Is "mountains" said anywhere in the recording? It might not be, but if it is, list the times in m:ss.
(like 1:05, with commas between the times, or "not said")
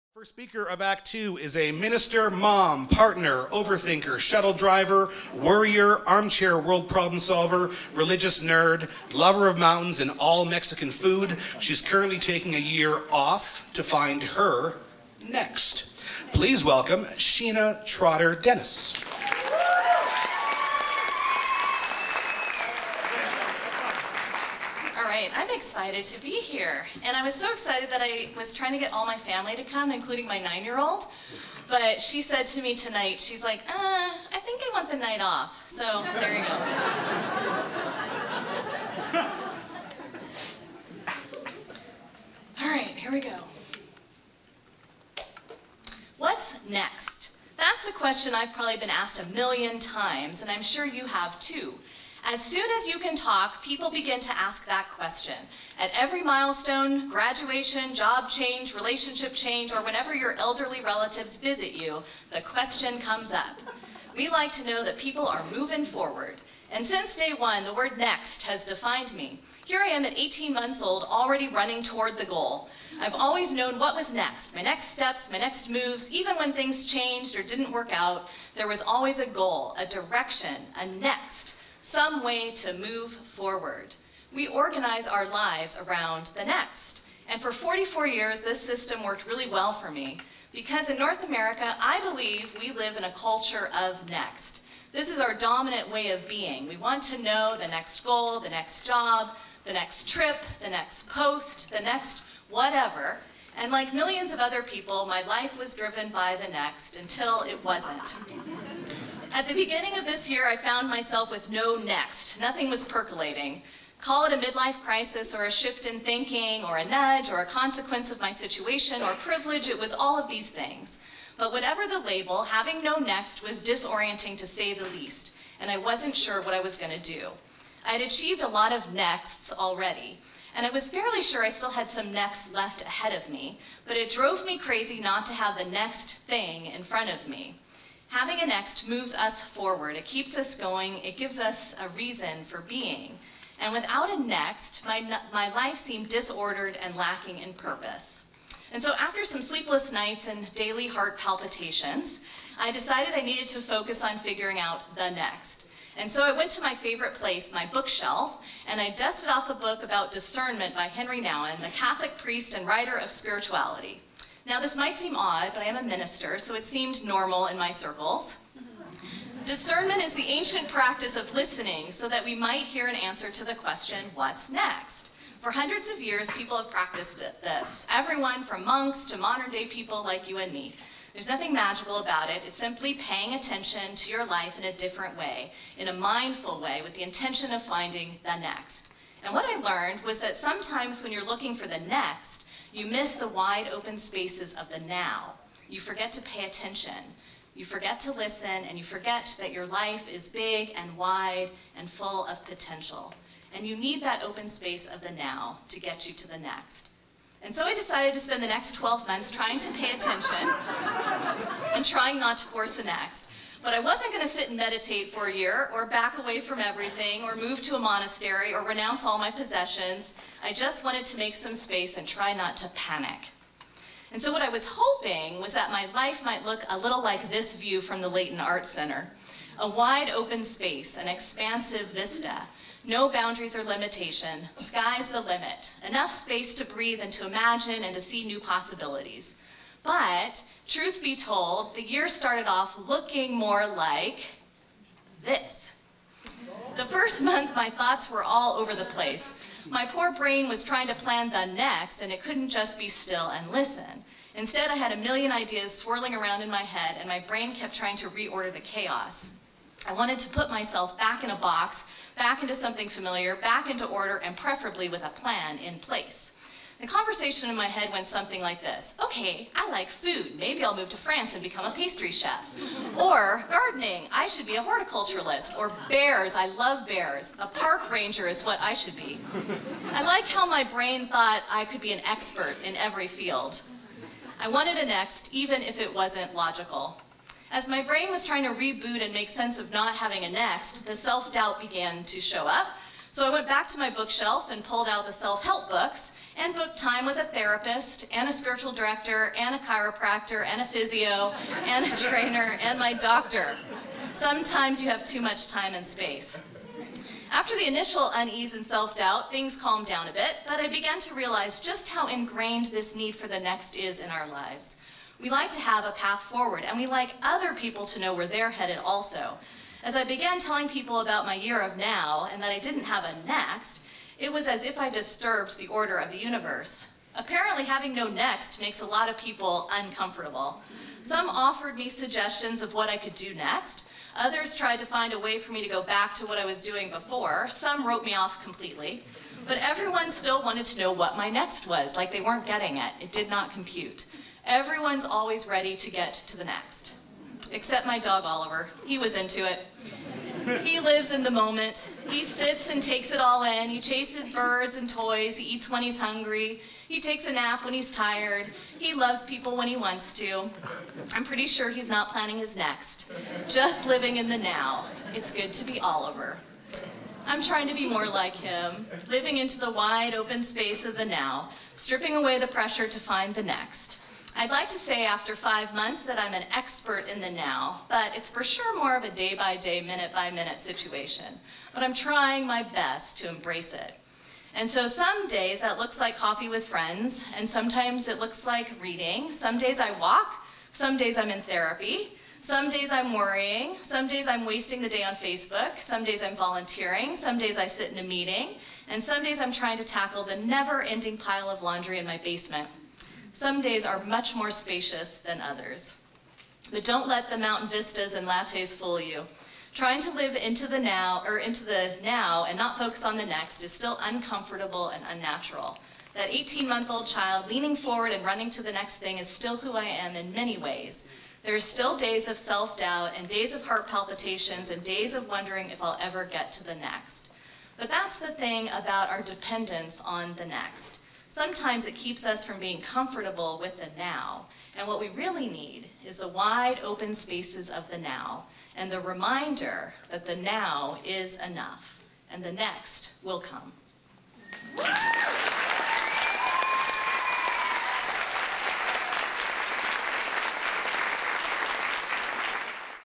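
0:09, 6:47.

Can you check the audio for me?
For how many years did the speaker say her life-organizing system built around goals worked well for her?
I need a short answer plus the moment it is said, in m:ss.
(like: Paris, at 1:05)
44, at 1:27.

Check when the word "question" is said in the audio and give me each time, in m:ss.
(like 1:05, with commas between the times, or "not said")
0:47, 0:54, 1:02, 2:53.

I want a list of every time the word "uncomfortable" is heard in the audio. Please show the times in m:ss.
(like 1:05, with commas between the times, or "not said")
5:29, 6:54.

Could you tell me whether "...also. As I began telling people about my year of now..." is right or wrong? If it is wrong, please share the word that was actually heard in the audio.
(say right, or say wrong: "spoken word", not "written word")
right.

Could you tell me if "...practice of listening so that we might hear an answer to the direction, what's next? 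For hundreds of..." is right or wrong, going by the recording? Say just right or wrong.
wrong.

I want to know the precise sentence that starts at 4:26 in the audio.
The conversation in my head went something like this.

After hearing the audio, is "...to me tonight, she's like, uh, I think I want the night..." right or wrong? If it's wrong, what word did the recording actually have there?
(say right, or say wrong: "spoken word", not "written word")
right.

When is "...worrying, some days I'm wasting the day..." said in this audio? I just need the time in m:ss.
6:33.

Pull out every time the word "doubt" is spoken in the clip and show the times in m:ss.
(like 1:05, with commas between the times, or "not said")
4:50, 5:08, 7:02.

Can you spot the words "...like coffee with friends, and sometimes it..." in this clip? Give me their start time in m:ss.
6:25.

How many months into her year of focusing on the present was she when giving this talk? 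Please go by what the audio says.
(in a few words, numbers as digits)
5.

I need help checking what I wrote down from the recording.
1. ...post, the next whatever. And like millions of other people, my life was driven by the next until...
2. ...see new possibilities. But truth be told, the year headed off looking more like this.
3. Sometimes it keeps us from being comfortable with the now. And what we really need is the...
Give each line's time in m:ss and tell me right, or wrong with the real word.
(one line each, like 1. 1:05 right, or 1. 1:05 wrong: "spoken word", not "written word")
1. 1:41 right
2. 3:58 wrong: "started", not "headed"
3. 7:11 right.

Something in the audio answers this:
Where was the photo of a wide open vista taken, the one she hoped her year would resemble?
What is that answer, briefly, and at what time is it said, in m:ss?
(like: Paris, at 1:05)
Leighton Art Center, at 3:48.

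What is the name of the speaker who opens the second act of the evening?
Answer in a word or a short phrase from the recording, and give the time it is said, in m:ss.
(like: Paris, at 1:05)
Sheena Trotter Dennis, at 0:17.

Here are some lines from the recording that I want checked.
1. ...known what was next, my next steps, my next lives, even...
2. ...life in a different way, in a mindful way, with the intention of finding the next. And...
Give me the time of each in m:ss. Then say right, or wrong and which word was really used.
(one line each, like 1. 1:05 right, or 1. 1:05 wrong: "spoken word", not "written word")
1. 1:13 wrong: "moves", not "lives"
2. 3:04 right.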